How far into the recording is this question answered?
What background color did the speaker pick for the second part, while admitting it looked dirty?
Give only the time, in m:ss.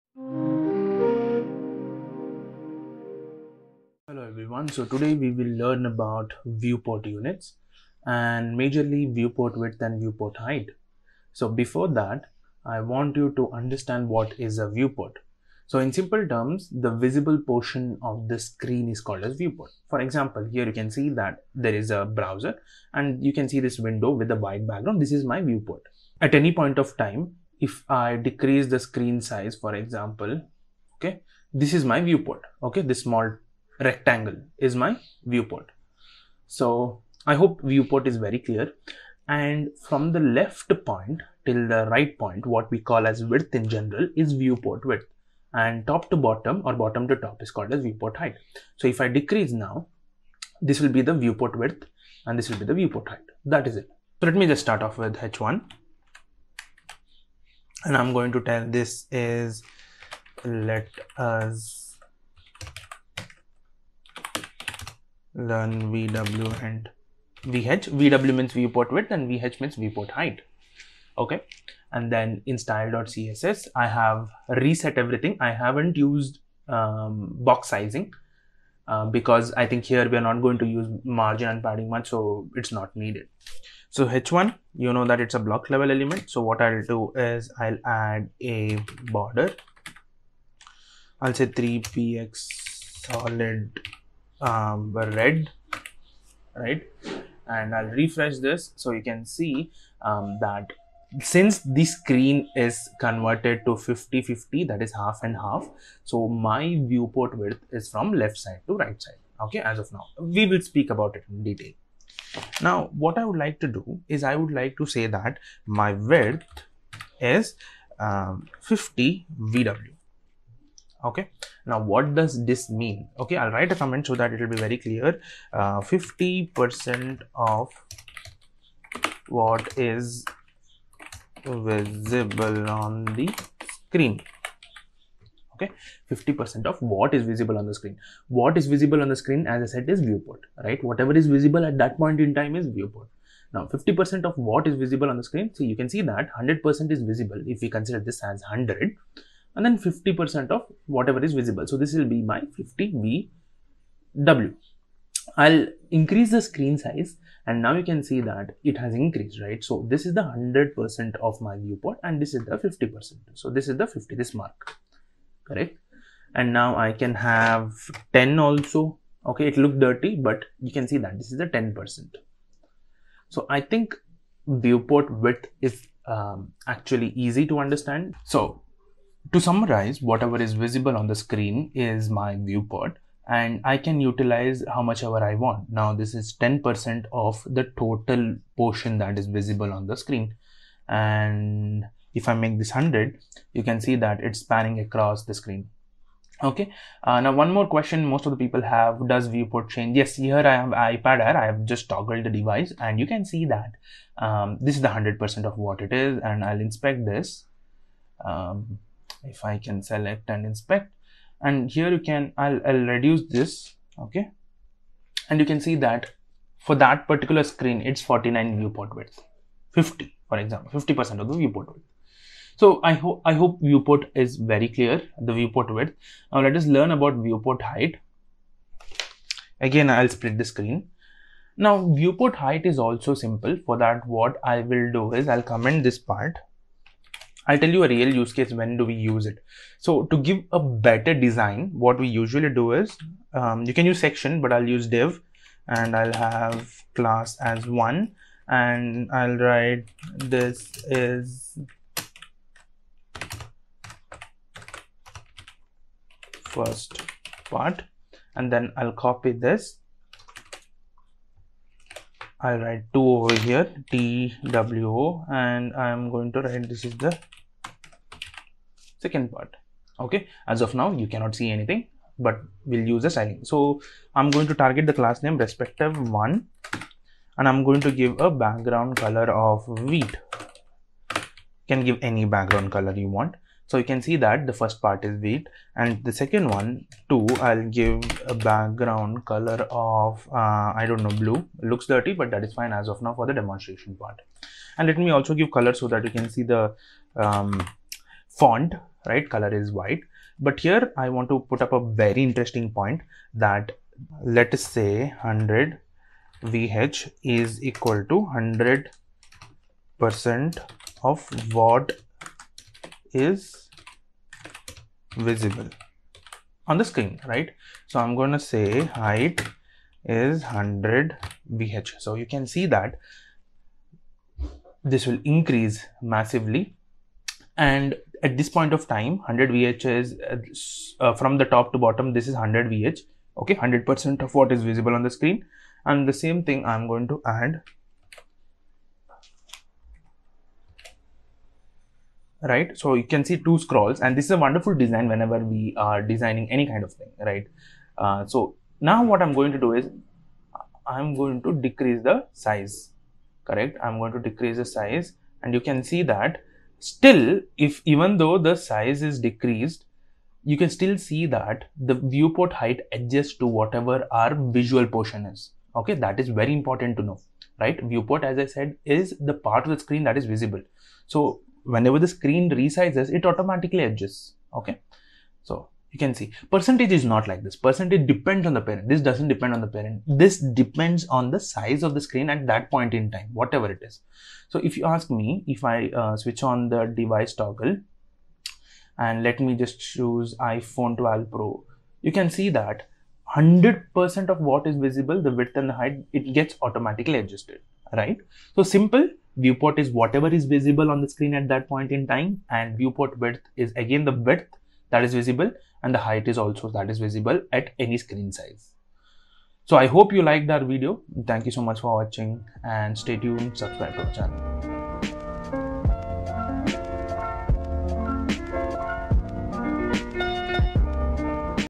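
4:51.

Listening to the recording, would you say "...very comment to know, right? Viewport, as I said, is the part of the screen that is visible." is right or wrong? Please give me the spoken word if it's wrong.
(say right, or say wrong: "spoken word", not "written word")
wrong: "important", not "comment".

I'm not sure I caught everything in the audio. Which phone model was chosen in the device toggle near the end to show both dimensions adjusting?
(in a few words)
iPhone 12 Pro.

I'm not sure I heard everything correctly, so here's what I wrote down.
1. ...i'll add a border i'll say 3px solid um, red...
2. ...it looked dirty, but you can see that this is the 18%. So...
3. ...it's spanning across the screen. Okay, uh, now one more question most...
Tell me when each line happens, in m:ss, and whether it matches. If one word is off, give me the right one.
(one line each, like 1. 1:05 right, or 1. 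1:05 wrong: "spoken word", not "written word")
1. 1:27 right
2. 2:49 wrong: "10", not "18"
3. 3:14 right.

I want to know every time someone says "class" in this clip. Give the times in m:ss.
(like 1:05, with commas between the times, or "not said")
4:06, 4:35.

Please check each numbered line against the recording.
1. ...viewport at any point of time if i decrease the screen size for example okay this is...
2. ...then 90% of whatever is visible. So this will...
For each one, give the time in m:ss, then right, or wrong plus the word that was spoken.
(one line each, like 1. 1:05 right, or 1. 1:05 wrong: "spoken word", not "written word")
1. 0:25 right
2. 2:29 wrong: "50", not "90".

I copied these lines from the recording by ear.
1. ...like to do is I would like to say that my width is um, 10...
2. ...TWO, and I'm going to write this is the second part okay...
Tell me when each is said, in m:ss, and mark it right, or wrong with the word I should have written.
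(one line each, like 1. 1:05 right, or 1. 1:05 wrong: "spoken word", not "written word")
1. 1:53 wrong: "50", not "10"
2. 4:23 right.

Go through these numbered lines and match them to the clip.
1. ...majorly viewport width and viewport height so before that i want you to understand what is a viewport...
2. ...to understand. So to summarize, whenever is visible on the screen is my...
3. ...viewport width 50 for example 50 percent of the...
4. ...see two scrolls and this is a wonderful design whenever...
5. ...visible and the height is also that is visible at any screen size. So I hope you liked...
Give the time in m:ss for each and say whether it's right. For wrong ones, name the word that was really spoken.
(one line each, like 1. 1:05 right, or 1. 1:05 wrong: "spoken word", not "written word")
1. 0:08 right
2. 2:57 wrong: "whatever", not "whenever"
3. 3:38 right
4. 5:43 right
5. 6:45 right.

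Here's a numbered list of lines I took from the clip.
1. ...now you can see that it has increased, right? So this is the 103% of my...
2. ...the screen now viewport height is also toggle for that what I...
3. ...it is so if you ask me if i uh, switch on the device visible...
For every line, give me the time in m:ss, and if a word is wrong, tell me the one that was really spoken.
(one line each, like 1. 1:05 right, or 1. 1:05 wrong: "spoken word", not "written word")
1. 2:37 wrong: "100", not "103"
2. 3:50 wrong: "simple", not "toggle"
3. 6:23 wrong: "toggle", not "visible".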